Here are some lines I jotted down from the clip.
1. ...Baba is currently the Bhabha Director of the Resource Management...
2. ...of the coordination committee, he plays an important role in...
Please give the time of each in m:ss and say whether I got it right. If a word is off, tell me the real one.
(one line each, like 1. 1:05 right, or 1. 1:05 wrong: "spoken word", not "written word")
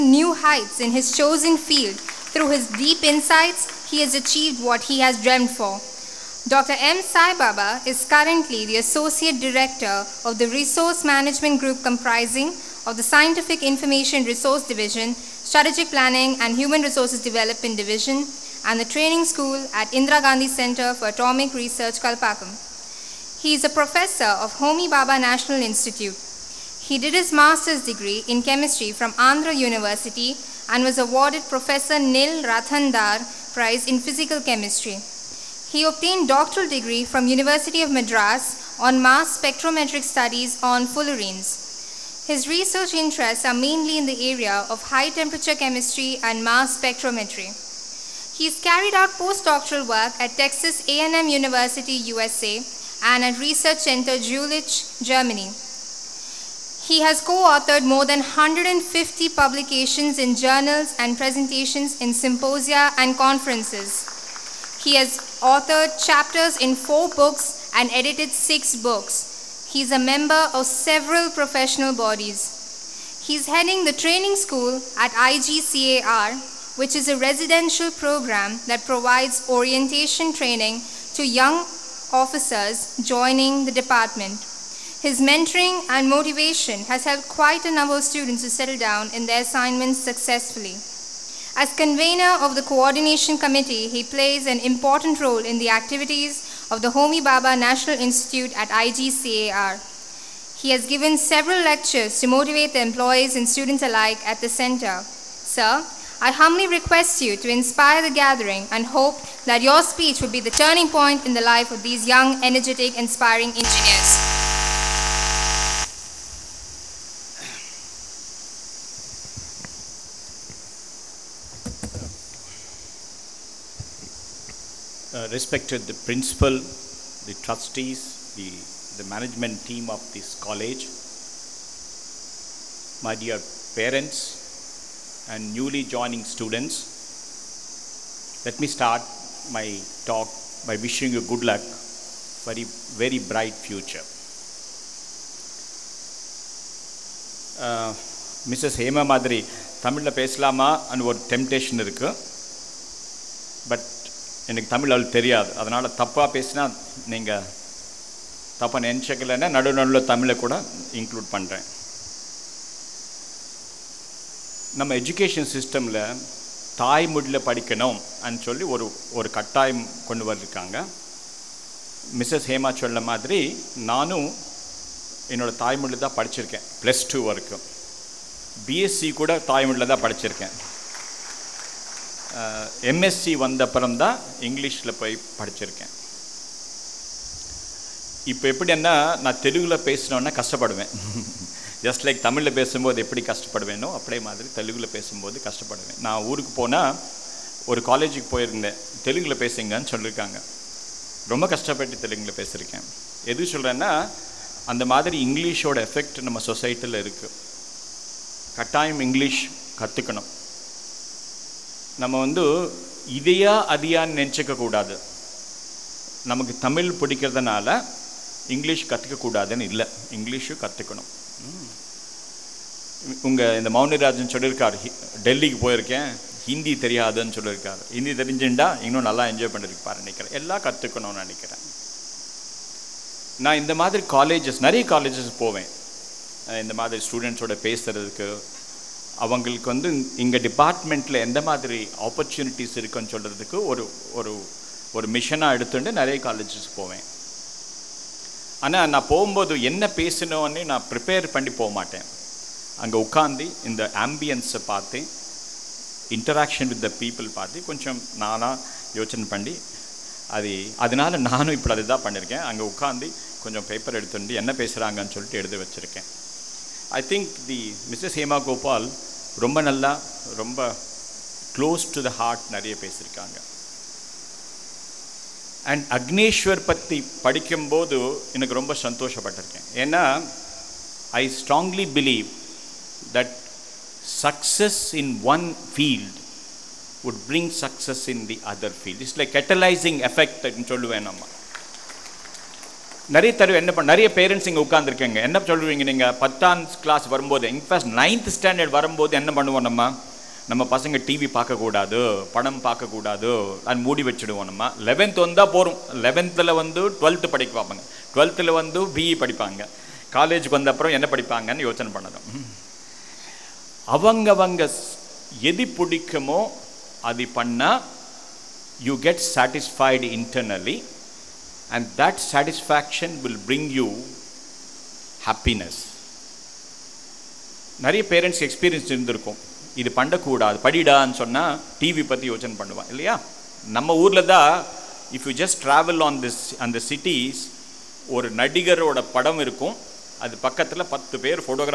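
1. 0:07 wrong: "Associate", not "Bhabha"
2. 1:32 right.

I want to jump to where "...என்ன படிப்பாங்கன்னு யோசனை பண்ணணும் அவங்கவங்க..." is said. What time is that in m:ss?
5:10.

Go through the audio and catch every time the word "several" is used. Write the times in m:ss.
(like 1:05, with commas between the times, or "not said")
1:10, 1:41.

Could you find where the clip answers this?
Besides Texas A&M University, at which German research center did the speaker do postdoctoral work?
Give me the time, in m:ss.
0:53.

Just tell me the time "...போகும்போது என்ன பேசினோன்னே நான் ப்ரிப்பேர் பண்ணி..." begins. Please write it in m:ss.
4:09.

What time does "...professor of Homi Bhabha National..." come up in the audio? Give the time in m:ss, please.
0:23.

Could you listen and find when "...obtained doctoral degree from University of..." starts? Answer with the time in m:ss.
0:35.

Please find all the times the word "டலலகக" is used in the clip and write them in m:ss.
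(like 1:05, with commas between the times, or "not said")
3:45.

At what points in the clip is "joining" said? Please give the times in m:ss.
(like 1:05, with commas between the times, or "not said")
1:23, 2:15.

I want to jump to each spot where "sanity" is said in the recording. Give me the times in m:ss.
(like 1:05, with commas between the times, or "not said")
not said.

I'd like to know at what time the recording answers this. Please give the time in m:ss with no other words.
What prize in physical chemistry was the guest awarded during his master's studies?
0:31.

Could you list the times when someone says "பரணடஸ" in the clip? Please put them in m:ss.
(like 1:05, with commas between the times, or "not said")
4:54, 5:28.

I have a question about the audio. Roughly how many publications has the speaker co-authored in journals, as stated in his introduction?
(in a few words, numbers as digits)
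more than 150.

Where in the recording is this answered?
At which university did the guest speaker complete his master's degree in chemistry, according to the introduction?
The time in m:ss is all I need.
0:29.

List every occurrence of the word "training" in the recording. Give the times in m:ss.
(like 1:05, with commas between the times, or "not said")
0:18, 1:13, 1:20.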